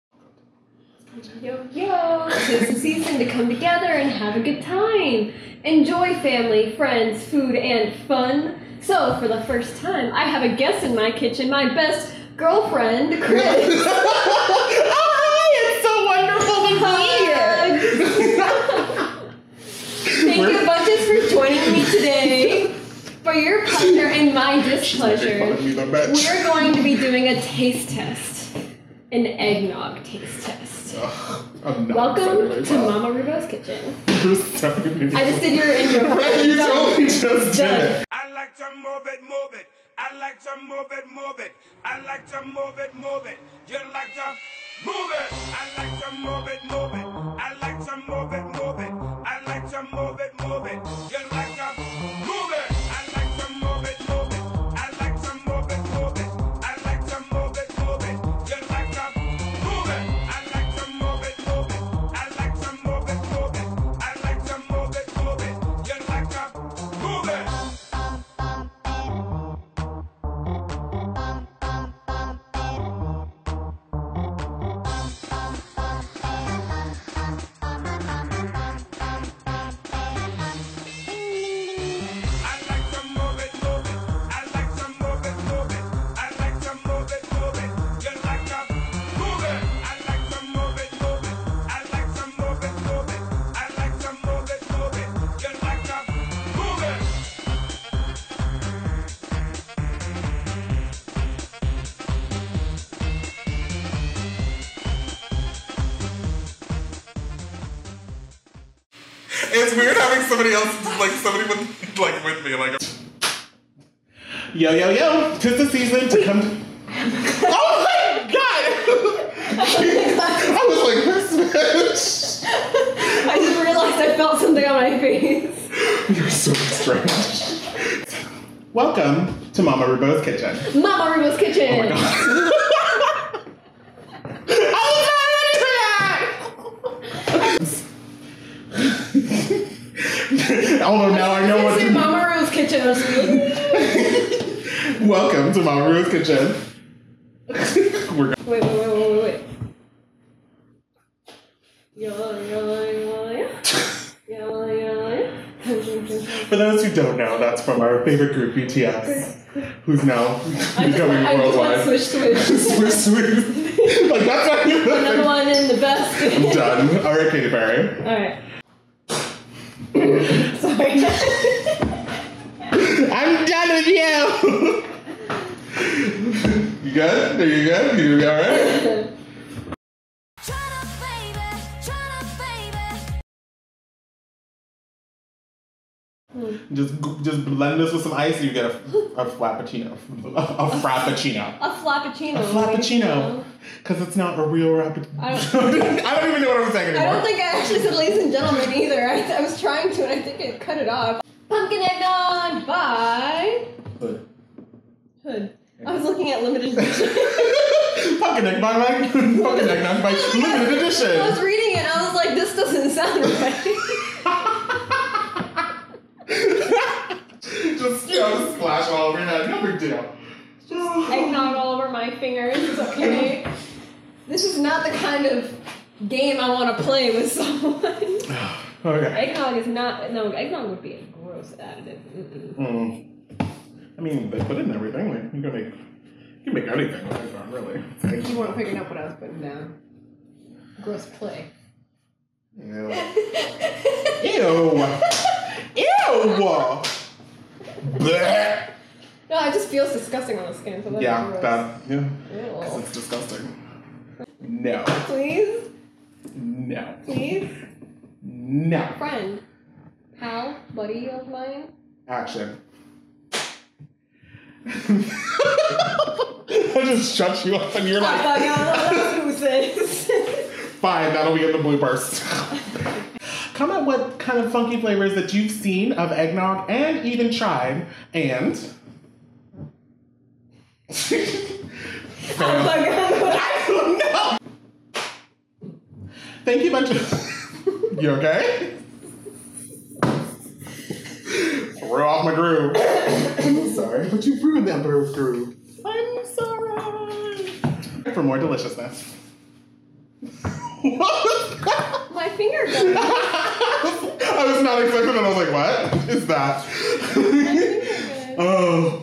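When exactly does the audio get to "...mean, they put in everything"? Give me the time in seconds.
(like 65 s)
234 s.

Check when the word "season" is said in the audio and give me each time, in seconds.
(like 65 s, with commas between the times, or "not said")
2 s, 115 s.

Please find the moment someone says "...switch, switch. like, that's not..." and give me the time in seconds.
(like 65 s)
162 s.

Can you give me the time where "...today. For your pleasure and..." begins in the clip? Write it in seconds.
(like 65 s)
21 s.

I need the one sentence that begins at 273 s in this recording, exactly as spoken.
Comment what kind of funky flavors that you've seen of eggnog and even tried, and from, like, I don't know.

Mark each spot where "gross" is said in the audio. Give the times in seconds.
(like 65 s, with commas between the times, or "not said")
231 s, 240 s.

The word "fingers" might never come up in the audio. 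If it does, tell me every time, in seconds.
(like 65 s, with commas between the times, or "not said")
222 s, 302 s.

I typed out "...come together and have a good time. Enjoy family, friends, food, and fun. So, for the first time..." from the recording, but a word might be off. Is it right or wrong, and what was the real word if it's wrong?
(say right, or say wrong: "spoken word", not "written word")
right.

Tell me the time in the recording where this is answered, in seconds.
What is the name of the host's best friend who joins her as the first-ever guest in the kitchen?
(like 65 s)
13 s.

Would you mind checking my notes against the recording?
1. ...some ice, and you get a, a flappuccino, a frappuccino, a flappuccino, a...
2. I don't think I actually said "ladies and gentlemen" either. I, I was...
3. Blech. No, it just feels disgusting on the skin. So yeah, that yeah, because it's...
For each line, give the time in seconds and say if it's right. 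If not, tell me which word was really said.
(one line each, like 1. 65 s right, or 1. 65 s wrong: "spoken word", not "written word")
1. 188 s right
2. 197 s right
3. 247 s right.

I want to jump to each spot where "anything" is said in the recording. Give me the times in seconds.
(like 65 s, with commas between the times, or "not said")
236 s.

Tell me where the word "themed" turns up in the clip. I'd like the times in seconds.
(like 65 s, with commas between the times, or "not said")
not said.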